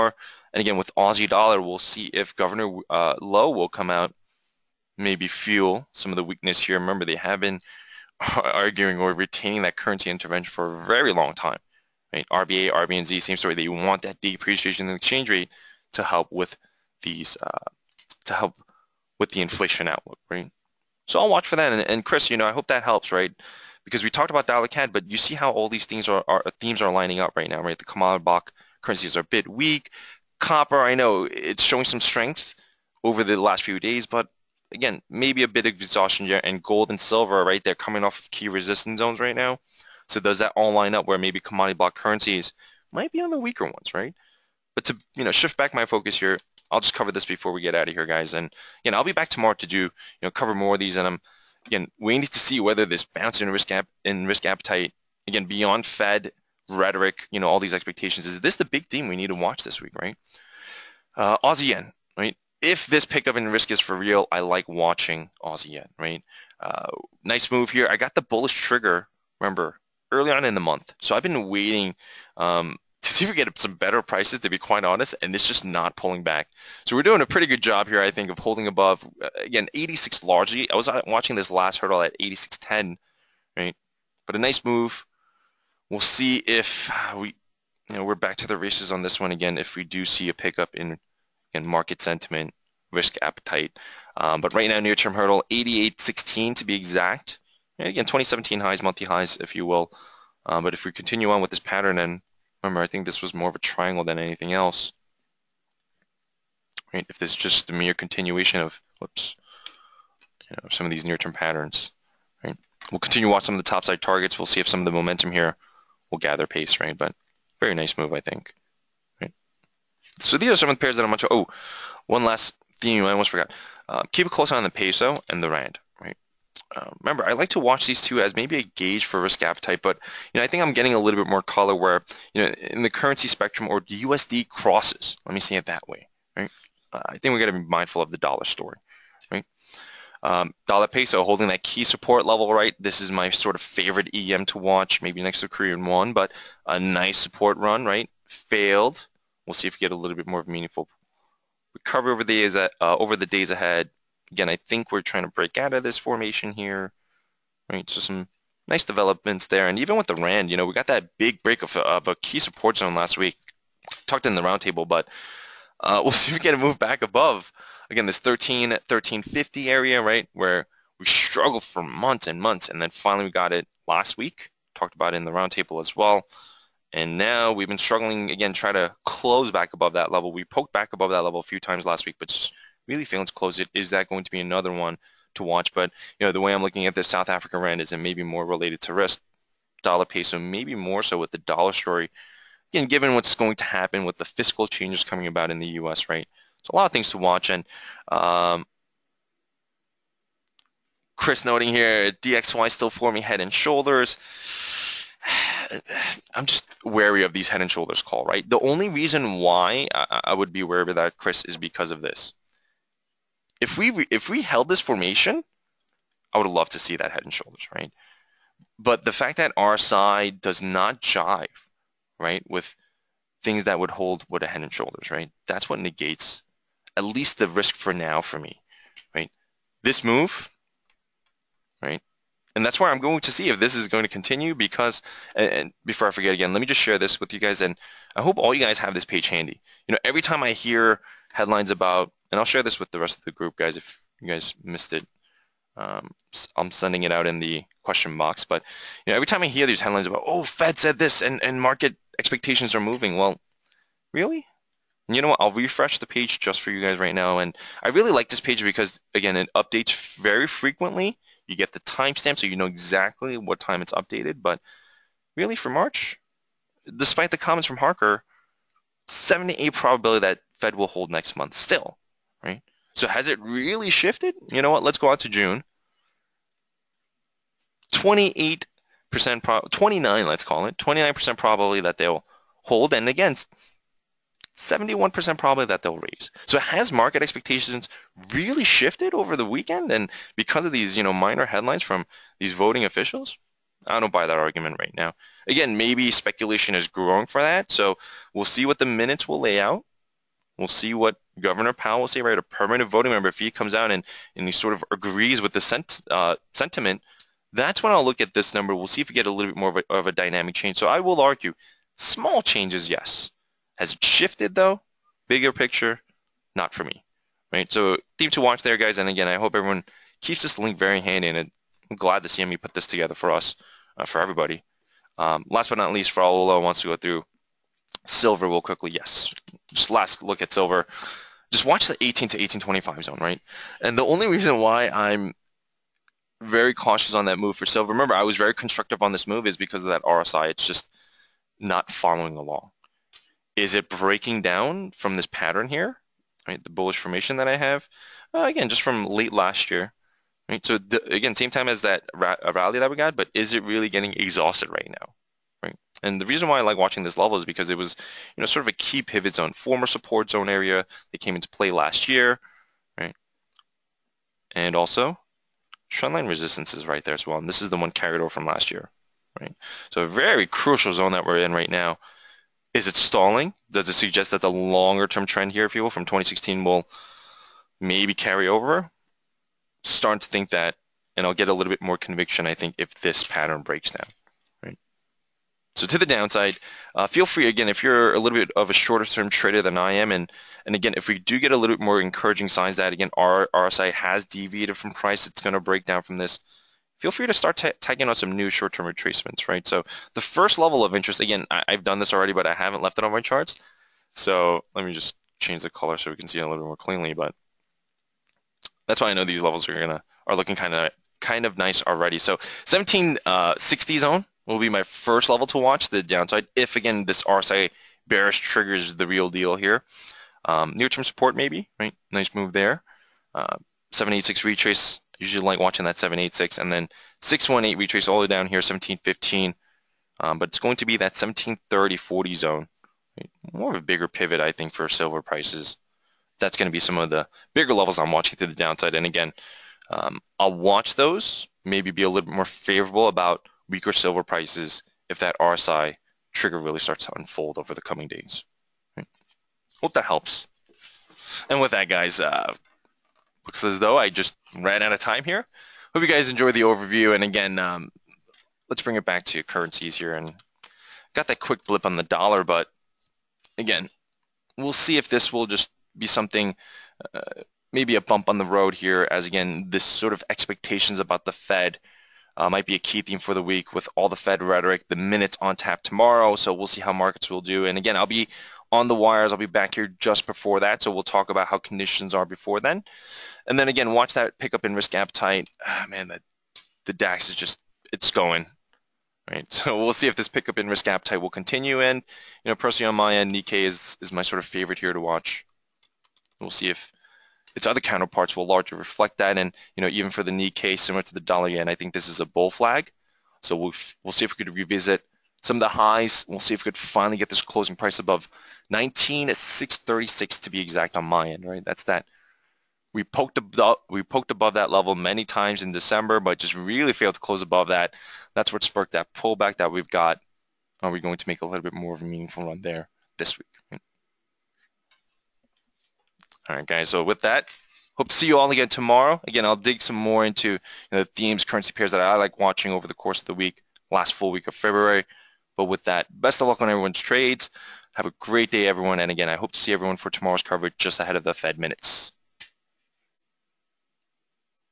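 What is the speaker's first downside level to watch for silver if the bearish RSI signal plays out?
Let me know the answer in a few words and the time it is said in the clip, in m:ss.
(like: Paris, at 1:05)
1760, at 6:52.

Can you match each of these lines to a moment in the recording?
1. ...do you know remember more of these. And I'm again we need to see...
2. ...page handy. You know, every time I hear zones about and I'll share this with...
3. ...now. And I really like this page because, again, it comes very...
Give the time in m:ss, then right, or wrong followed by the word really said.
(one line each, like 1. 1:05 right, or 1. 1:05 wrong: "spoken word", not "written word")
1. 0:49 wrong: "cover", not "remember"
2. 3:59 wrong: "headlines", not "zones"
3. 4:17 wrong: "updates", not "comes".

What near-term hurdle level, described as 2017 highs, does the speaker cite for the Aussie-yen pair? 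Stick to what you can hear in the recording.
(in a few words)
88.16.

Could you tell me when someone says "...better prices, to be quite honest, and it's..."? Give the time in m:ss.
1:13.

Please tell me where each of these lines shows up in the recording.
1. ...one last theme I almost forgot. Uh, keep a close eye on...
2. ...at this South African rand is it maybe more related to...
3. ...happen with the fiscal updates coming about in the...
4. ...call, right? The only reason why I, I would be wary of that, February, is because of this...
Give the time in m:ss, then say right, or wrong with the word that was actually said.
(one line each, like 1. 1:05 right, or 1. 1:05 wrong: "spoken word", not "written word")
1. 2:02 right
2. 3:06 right
3. 3:13 wrong: "changes", not "updates"
4. 3:28 wrong: "Chris", not "February".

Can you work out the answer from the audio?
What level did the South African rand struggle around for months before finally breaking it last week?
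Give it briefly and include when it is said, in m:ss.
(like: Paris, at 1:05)
1350, at 2:48.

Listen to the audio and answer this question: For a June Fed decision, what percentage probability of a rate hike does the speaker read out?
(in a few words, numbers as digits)
71%.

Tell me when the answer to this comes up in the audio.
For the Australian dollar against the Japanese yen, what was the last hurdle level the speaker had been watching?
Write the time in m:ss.
1:22.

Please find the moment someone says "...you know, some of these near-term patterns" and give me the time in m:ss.
1:50.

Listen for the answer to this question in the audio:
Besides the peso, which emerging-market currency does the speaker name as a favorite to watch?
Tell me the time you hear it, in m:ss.
2:25.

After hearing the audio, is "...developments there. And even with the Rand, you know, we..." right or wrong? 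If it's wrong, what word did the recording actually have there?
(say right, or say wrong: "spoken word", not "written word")
right.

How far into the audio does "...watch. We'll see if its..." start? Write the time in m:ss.
8:15.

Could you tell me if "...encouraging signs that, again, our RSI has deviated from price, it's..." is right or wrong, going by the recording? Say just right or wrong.
right.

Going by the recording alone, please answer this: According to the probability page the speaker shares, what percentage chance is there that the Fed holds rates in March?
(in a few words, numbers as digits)
78.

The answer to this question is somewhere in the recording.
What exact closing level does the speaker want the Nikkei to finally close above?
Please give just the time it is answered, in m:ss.
8:28.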